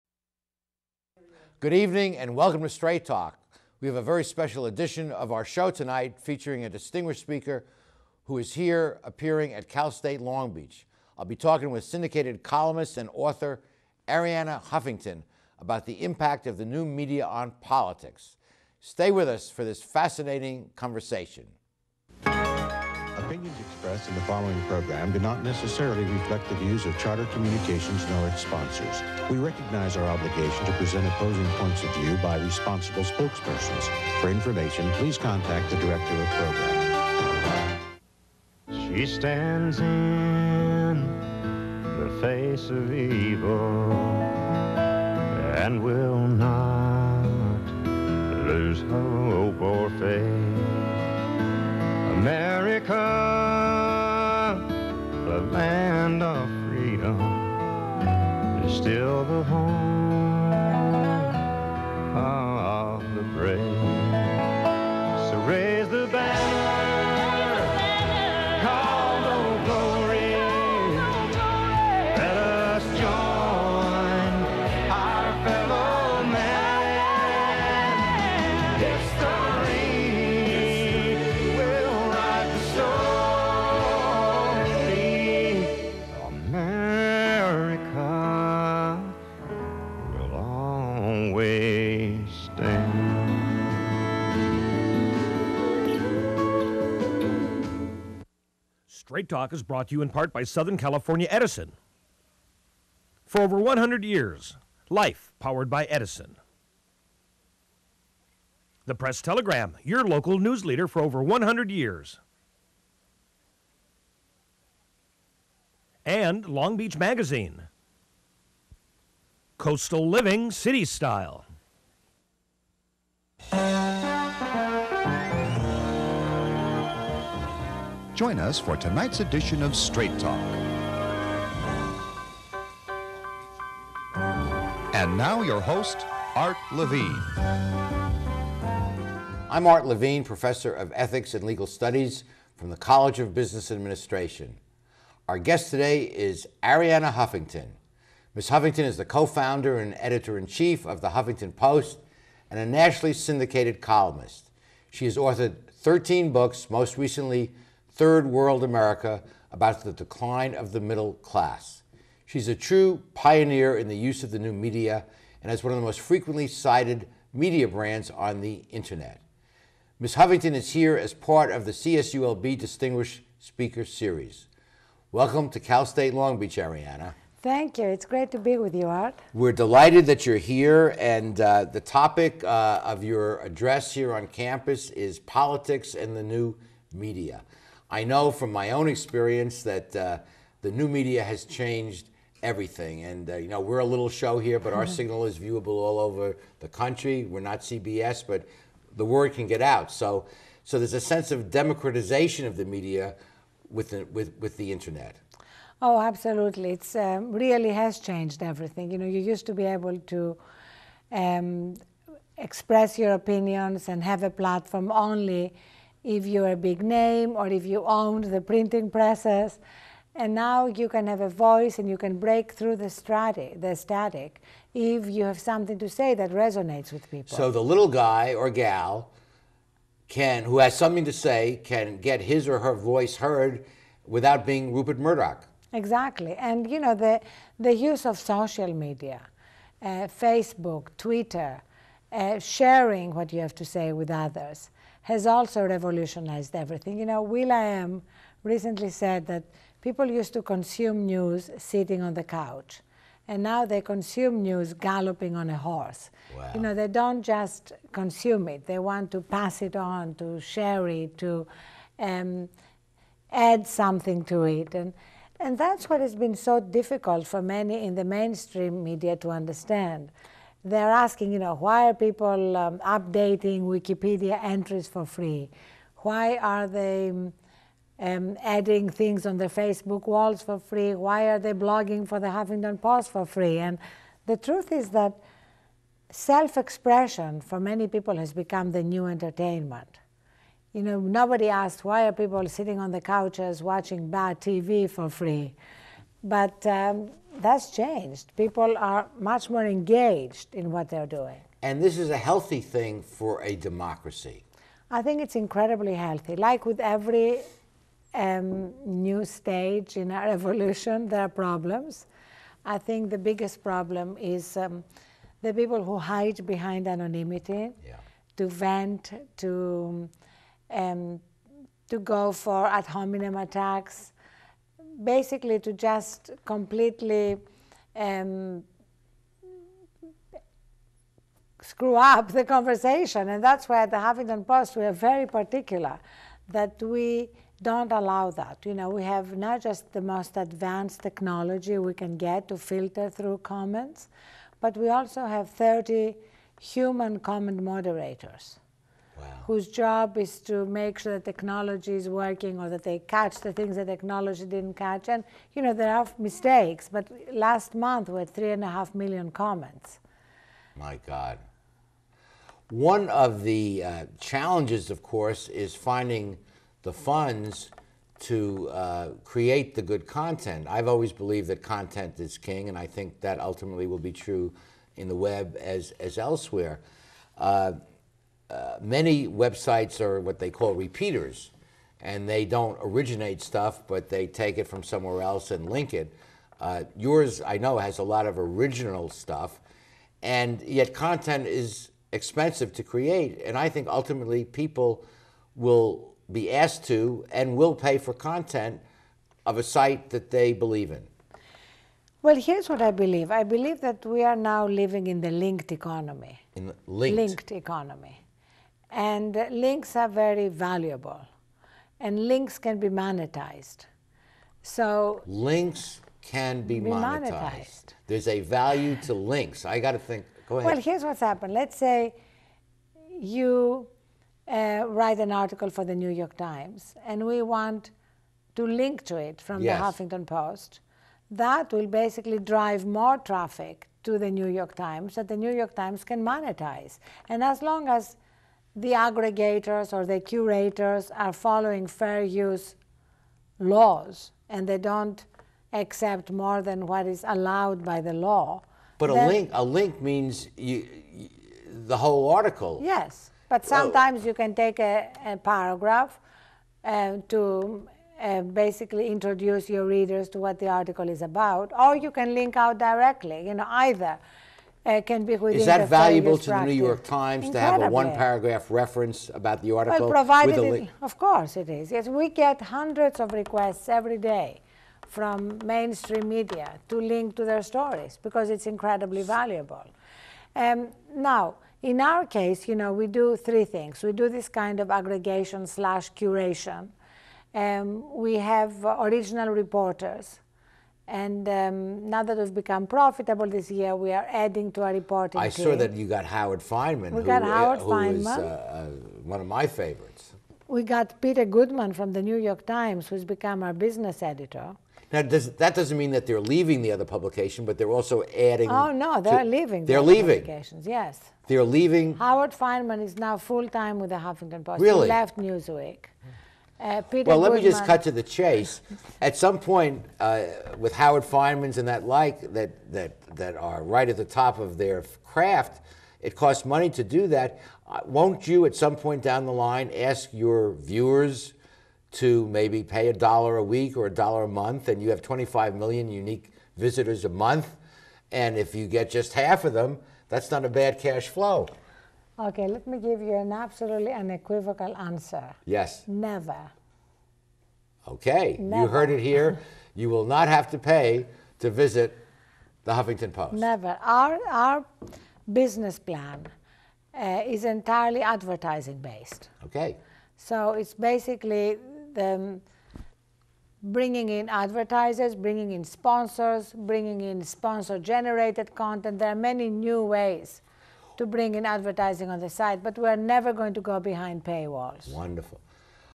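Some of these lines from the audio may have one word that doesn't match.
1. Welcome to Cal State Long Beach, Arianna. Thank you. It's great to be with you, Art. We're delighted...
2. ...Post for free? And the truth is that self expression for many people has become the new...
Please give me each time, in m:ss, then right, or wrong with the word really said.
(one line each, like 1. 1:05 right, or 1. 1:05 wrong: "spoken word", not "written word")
1. 2:55 right
2. 4:42 right.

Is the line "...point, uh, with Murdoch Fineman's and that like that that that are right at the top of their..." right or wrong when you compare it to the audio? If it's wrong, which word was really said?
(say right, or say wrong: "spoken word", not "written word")
wrong: "Howard", not "Murdoch".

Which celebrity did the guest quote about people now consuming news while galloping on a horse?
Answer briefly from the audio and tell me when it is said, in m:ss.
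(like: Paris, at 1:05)
Will I Am, at 4:07.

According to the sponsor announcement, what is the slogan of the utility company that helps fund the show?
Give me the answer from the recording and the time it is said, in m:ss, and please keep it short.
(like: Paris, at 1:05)
Life powered by Edison, at 1:44.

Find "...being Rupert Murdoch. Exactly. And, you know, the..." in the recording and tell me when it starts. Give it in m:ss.
3:54.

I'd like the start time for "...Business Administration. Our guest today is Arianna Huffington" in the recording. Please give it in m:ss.
2:23.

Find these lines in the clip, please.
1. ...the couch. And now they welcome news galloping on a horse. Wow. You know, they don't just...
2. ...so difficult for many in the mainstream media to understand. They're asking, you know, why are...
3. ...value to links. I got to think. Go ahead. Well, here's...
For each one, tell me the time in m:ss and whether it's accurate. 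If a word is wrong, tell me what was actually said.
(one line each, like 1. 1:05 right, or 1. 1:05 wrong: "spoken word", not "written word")
1. 4:12 wrong: "consume", not "welcome"
2. 4:26 right
3. 6:58 right.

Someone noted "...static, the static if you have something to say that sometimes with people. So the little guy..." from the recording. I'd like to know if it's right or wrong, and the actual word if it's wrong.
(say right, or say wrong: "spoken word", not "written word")
wrong: "resonates", not "sometimes".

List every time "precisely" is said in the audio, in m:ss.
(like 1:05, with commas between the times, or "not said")
not said.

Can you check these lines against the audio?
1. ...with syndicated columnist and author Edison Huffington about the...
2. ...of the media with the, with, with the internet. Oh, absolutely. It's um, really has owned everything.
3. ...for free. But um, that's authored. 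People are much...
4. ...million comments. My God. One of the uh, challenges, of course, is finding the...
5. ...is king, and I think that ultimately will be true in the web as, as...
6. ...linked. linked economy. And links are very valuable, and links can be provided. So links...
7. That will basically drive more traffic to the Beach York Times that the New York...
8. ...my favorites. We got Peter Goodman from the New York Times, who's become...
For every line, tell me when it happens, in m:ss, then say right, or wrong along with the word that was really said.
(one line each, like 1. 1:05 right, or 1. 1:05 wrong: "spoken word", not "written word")
1. 0:11 wrong: "Arianna", not "Edison"
2. 3:22 wrong: "changed", not "owned"
3. 4:54 wrong: "changed", not "authored"
4. 5:58 right
5. 6:12 right
6. 6:46 wrong: "monetized", not "provided"
7. 7:11 wrong: "New", not "Beach"
8. 8:19 right.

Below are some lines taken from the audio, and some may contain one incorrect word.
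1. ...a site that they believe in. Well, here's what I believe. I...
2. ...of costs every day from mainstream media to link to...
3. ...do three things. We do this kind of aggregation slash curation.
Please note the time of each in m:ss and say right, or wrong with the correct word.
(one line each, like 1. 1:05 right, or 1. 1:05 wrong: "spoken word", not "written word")
1. 6:39 right
2. 7:53 wrong: "requests", not "costs"
3. 8:03 right.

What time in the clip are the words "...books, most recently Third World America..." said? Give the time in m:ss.
2:36.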